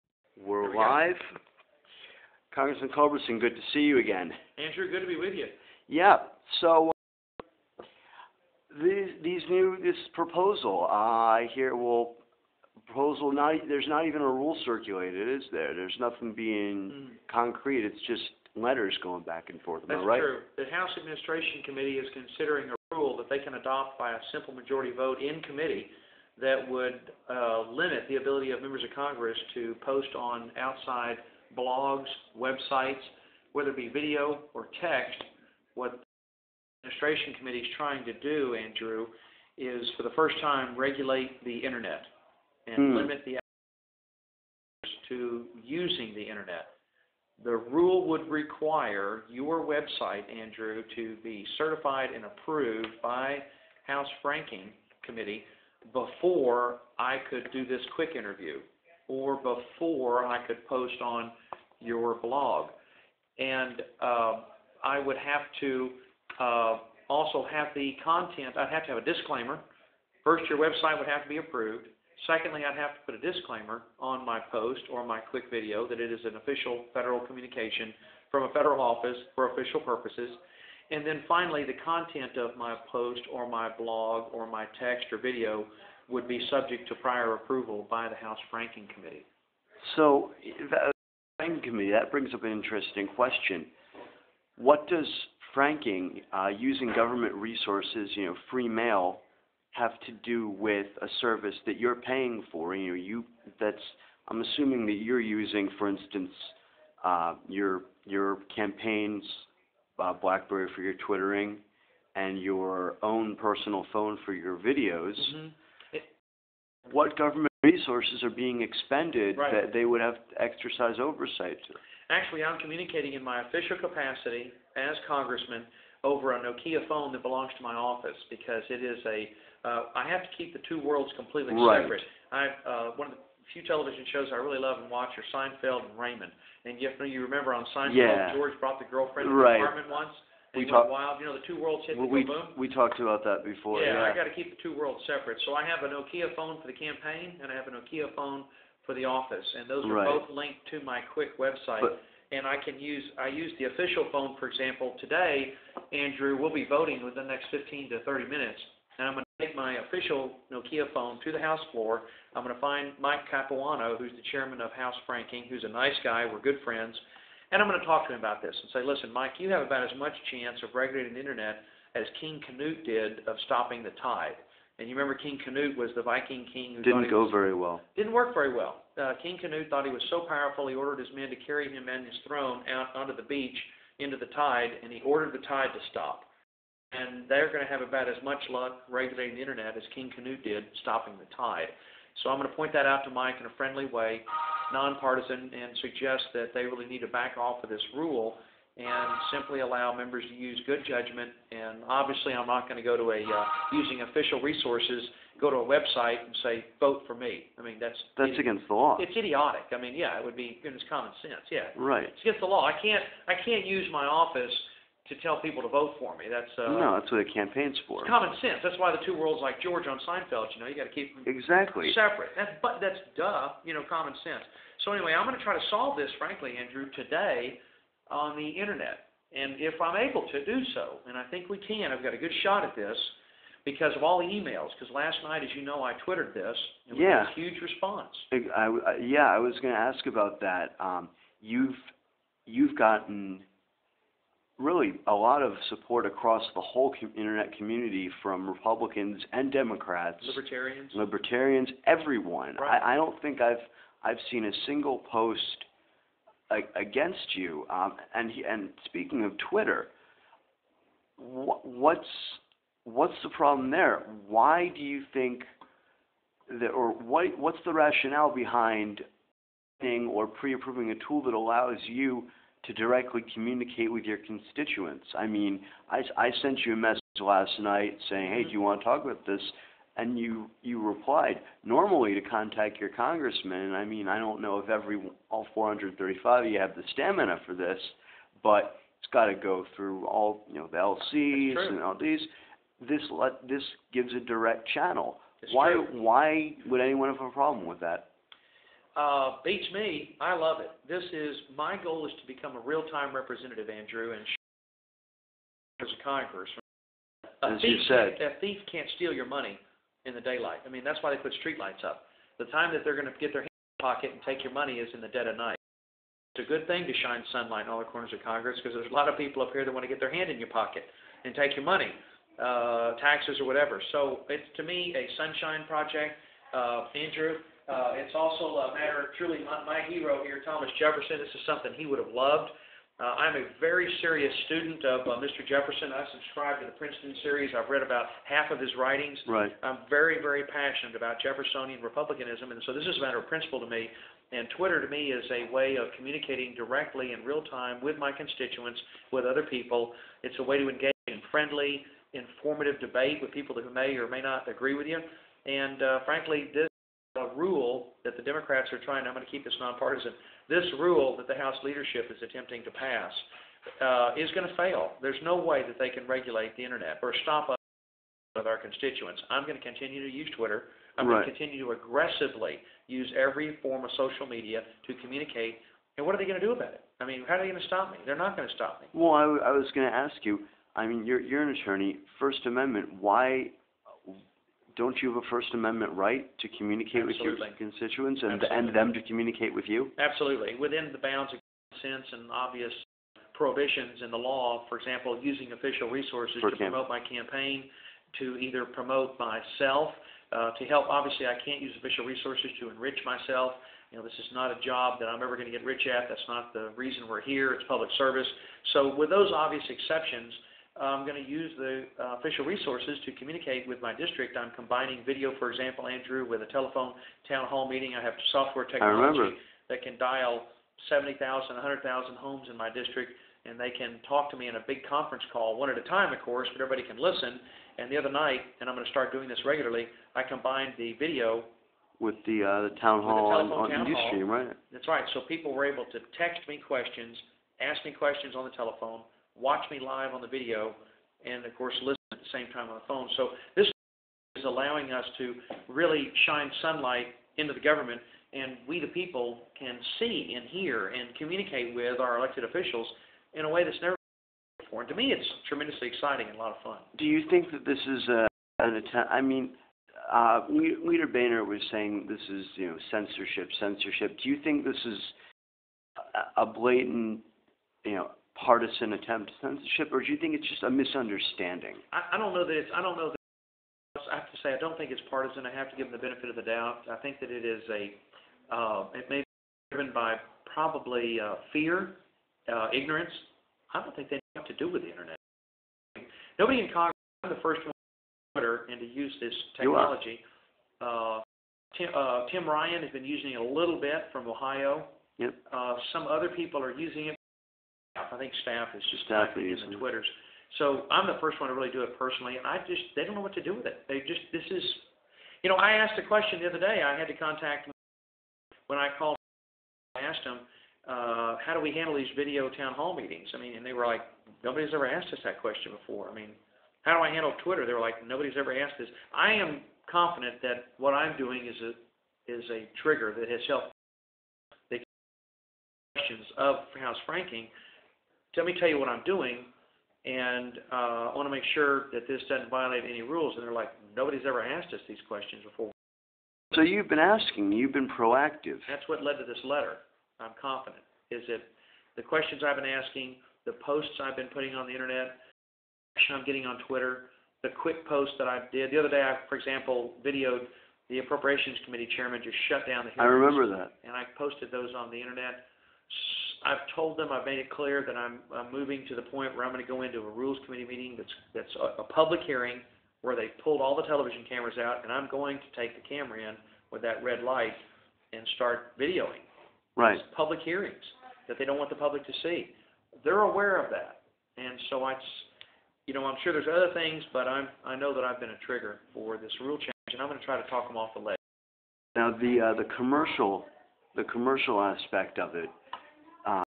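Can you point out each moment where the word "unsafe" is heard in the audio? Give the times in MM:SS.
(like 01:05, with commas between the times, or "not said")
not said.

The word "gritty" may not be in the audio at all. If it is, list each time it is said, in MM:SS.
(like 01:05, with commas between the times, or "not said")
not said.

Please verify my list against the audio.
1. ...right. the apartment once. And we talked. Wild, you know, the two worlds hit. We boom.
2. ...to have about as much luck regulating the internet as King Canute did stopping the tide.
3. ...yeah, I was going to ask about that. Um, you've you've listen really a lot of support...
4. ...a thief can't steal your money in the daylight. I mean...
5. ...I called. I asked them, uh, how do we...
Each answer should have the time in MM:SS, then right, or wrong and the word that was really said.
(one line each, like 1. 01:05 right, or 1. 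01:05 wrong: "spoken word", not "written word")
1. 02:19 right
2. 03:07 right
3. 03:58 wrong: "gotten", not "listen"
4. 05:08 right
5. 08:28 right.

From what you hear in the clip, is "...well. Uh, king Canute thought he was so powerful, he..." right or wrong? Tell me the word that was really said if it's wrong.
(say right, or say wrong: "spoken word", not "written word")
right.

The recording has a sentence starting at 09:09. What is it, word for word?
I, for example, videoed the appropriations committee chairman just shut down the hearings.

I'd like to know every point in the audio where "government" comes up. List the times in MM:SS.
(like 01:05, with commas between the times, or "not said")
01:36, 01:57, 07:27.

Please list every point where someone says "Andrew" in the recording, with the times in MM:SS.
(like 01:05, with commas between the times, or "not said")
00:04, 00:38, 00:50, 02:35, 03:46, 05:03, 05:26, 06:55.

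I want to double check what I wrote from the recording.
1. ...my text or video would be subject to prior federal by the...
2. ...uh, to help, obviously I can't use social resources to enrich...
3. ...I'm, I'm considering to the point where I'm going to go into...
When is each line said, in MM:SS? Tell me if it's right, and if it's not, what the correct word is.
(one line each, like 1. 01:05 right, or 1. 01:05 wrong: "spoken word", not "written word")
1. 01:24 wrong: "approval", not "federal"
2. 06:40 wrong: "official", not "social"
3. 09:17 wrong: "moving", not "considering".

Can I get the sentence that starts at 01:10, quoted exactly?
First, your website would have to be approved.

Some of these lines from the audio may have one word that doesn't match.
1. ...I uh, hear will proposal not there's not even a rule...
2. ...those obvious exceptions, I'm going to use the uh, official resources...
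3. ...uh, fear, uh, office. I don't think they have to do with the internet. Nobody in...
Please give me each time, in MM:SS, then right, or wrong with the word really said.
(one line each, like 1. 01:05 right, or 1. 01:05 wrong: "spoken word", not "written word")
1. 00:10 right
2. 06:49 right
3. 08:01 wrong: "ignorance", not "office".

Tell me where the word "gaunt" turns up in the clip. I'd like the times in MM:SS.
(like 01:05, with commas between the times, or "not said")
not said.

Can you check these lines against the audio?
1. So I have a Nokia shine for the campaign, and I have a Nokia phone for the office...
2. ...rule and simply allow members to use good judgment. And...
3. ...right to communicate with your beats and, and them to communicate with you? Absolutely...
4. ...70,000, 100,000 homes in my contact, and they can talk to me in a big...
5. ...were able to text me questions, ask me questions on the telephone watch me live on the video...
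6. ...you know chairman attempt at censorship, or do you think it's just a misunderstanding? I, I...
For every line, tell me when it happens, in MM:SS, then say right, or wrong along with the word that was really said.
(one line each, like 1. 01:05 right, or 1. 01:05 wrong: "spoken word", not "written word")
1. 02:25 wrong: "phone", not "shine"
2. 03:17 right
3. 06:25 wrong: "constituents", not "beats"
4. 07:00 wrong: "district", not "contact"
5. 07:15 right
6. 07:47 wrong: "partisan", not "chairman".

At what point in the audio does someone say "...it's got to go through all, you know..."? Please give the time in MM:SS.
04:48.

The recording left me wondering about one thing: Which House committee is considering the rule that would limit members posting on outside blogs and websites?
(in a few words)
House Administration Committee.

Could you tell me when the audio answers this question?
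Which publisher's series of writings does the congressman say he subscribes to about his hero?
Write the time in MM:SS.
05:36.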